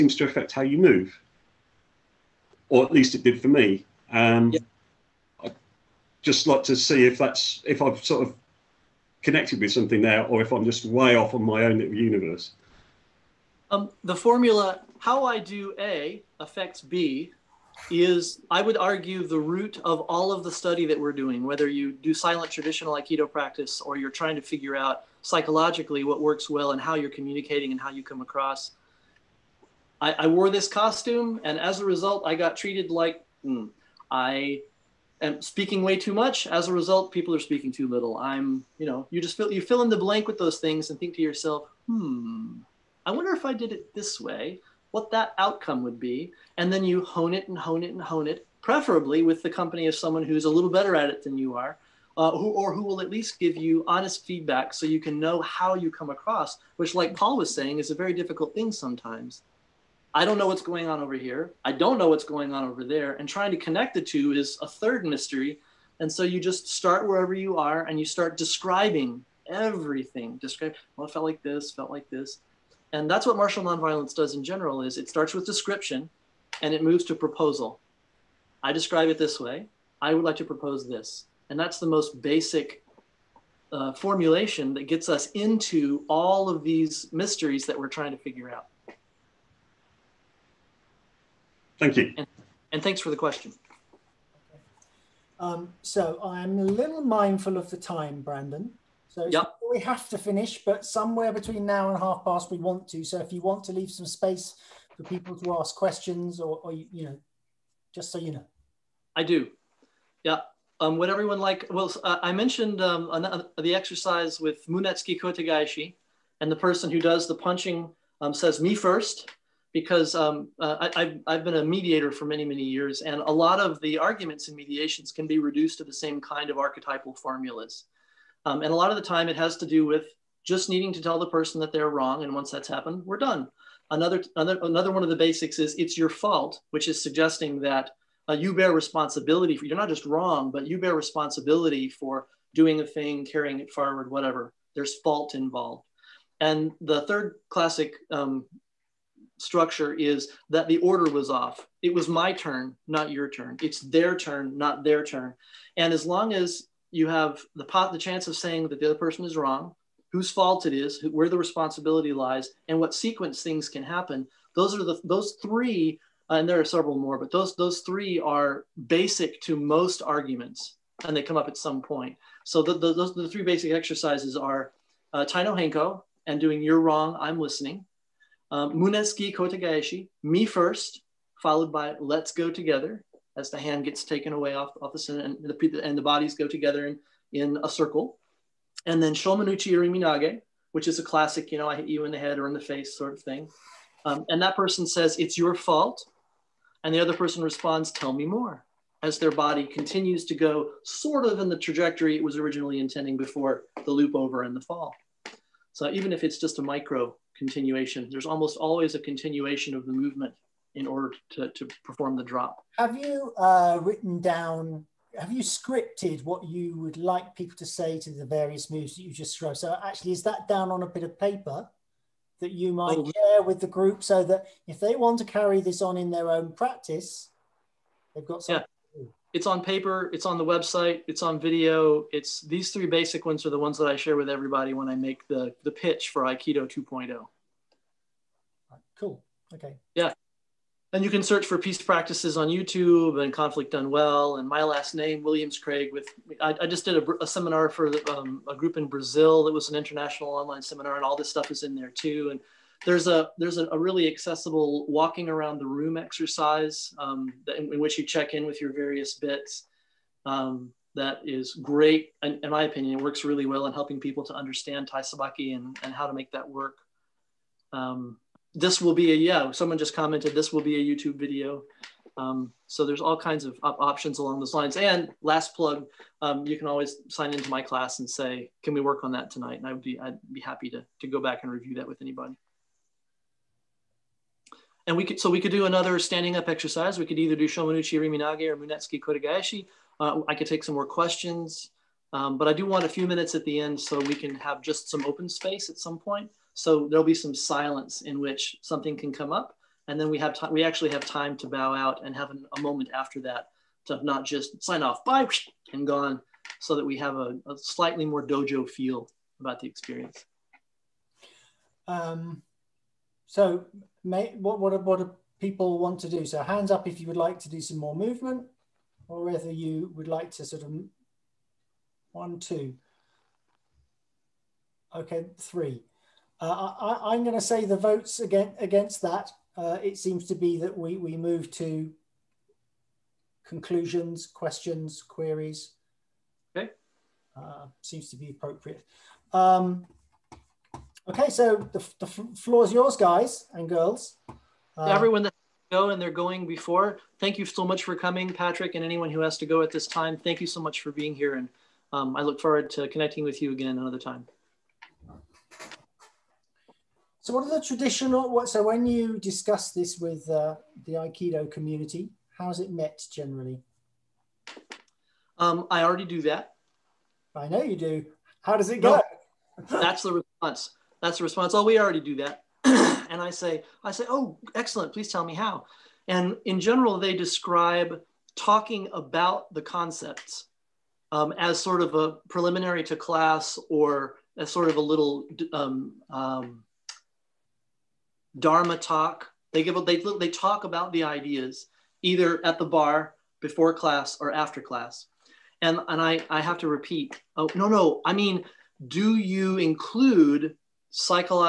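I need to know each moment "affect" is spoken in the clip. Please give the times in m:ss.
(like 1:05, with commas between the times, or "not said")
0:00, 0:16.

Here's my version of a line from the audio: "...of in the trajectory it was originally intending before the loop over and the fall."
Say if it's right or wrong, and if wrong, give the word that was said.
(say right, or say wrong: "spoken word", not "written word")
right.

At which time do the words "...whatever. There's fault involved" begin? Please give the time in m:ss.
2:24.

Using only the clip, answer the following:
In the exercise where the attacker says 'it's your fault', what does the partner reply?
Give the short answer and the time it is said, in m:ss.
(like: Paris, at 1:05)
Tell me more, at 3:17.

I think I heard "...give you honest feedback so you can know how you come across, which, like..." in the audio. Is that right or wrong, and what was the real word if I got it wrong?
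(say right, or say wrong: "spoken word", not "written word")
right.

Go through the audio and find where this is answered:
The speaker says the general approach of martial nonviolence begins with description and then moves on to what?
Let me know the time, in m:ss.
1:17.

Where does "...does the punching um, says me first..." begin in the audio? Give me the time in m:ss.
1:56.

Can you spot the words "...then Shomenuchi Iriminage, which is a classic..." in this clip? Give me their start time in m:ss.
3:09.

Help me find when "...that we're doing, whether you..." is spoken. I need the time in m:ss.
0:20.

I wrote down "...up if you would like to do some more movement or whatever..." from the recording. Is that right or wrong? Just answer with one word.
wrong.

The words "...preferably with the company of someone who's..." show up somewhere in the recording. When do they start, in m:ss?
0:48.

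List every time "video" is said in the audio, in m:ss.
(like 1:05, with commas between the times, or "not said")
3:51, 4:31.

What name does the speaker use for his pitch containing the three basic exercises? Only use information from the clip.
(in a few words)
Aikido 2.0.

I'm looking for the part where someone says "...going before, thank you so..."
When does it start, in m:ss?
5:46.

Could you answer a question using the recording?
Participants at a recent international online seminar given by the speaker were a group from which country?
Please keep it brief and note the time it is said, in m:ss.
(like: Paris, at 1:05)
Brazil, at 4:08.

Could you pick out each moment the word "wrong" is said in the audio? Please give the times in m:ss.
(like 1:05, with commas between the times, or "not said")
2:11, 2:20, 2:39, 2:56.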